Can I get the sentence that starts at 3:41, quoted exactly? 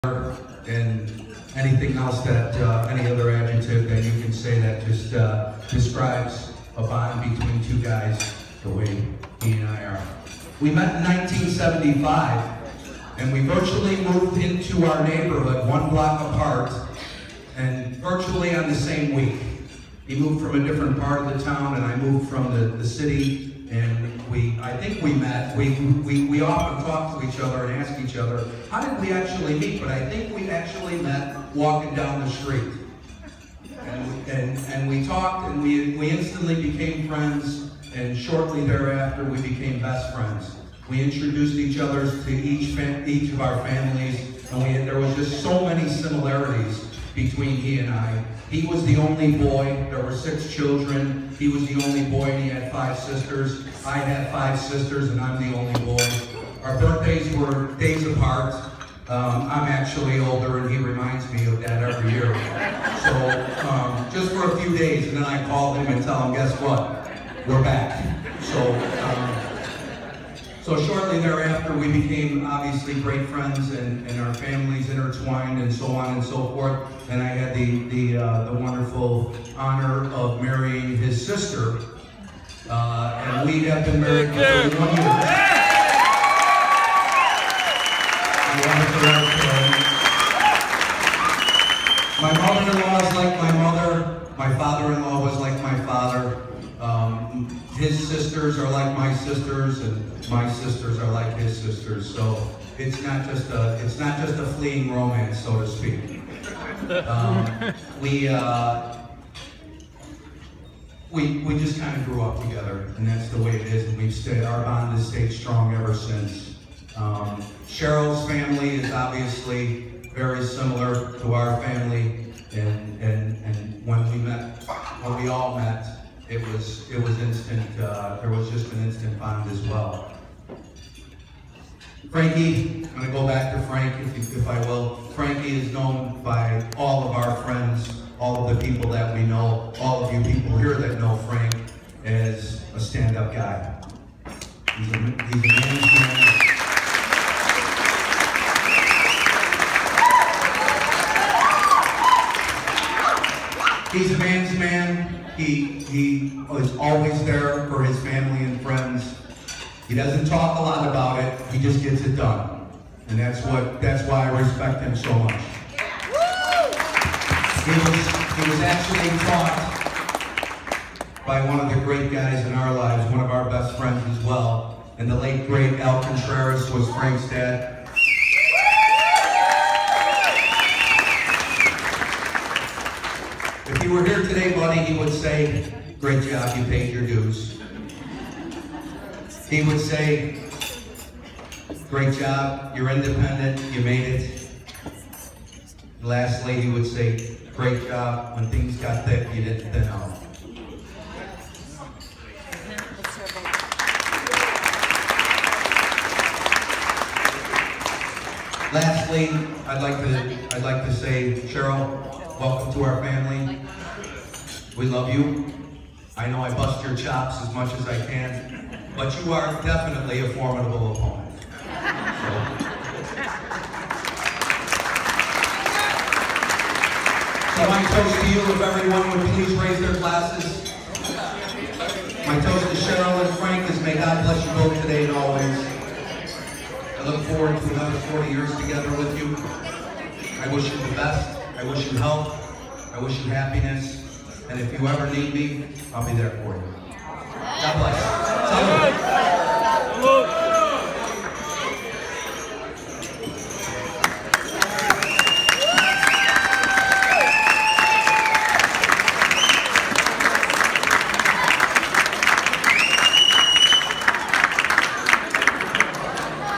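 So, So my toast to you, if everyone would please raise their glasses.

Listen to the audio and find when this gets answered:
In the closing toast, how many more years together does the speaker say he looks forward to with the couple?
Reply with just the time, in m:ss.
3:57.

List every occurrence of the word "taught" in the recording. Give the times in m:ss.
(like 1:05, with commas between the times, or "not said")
2:49.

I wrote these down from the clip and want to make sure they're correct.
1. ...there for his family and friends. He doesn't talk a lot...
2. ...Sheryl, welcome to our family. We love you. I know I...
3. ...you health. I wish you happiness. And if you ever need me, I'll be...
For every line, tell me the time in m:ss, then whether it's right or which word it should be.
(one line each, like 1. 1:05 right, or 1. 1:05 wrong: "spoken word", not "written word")
1. 2:37 right
2. 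3:31 right
3. 4:01 right.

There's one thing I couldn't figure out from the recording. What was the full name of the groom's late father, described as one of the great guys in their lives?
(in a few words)
Al Contreras.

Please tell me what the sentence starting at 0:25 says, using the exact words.
We we, we often talk to each other and ask each other, how did we actually meet?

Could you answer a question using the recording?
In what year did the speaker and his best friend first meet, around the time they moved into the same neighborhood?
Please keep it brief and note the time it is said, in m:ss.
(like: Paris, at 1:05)
1975, at 0:11.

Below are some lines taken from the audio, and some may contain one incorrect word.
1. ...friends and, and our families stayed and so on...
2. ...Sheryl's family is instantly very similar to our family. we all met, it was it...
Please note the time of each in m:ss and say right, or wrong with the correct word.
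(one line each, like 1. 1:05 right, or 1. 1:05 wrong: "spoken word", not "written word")
1. 1:13 wrong: "intertwined", not "stayed"
2. 1:57 wrong: "obviously", not "instantly".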